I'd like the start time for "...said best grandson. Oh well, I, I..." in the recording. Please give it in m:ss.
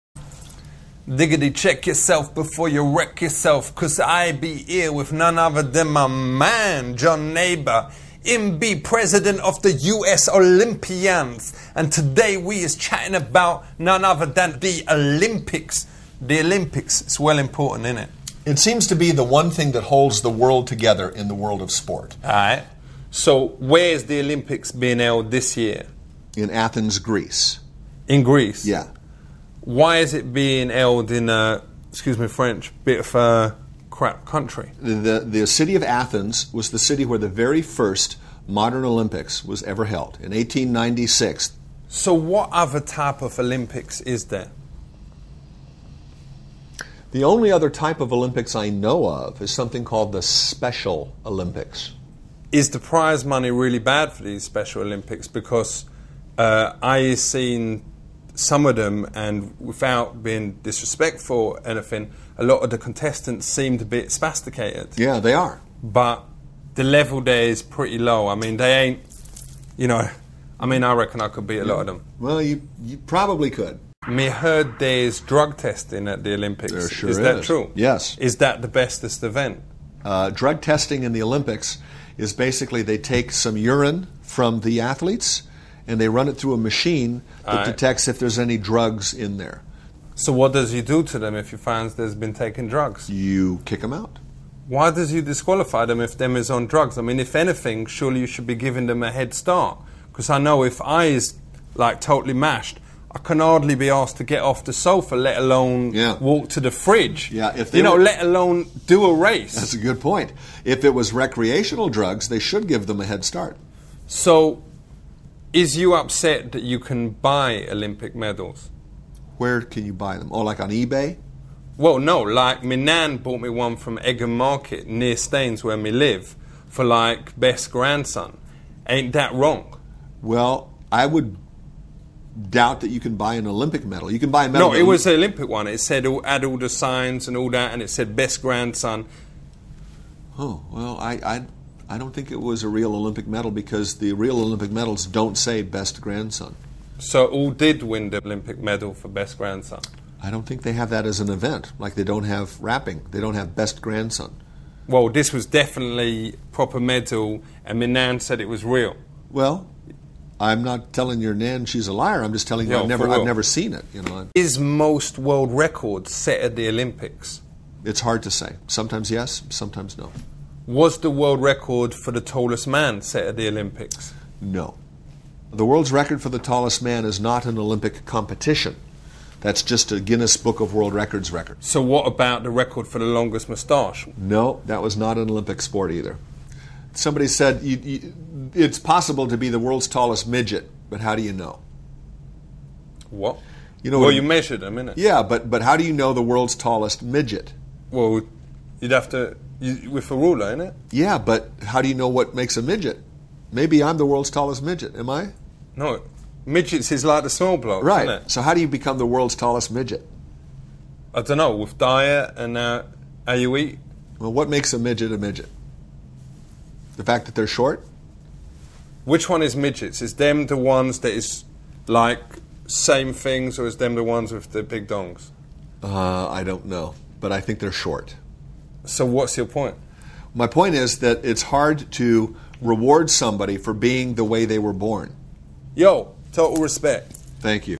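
2:17.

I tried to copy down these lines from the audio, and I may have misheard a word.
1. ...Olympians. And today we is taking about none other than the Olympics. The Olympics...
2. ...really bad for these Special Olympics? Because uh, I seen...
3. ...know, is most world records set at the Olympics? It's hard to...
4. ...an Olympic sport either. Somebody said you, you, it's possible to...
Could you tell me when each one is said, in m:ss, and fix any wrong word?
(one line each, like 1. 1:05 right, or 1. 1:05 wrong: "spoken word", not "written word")
1. 0:10 wrong: "chatting", not "taking"
2. 0:53 right
3. 2:44 right
4. 3:05 right.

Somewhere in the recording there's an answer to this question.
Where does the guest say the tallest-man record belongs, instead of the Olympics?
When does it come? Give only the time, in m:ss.
2:59.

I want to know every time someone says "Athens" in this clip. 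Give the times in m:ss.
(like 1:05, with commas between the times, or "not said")
0:26, 0:35.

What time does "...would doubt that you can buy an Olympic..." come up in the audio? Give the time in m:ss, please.
2:11.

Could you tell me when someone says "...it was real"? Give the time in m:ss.
2:38.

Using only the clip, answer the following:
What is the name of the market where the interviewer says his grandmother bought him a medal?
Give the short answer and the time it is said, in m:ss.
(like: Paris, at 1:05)
Egham Market, at 2:03.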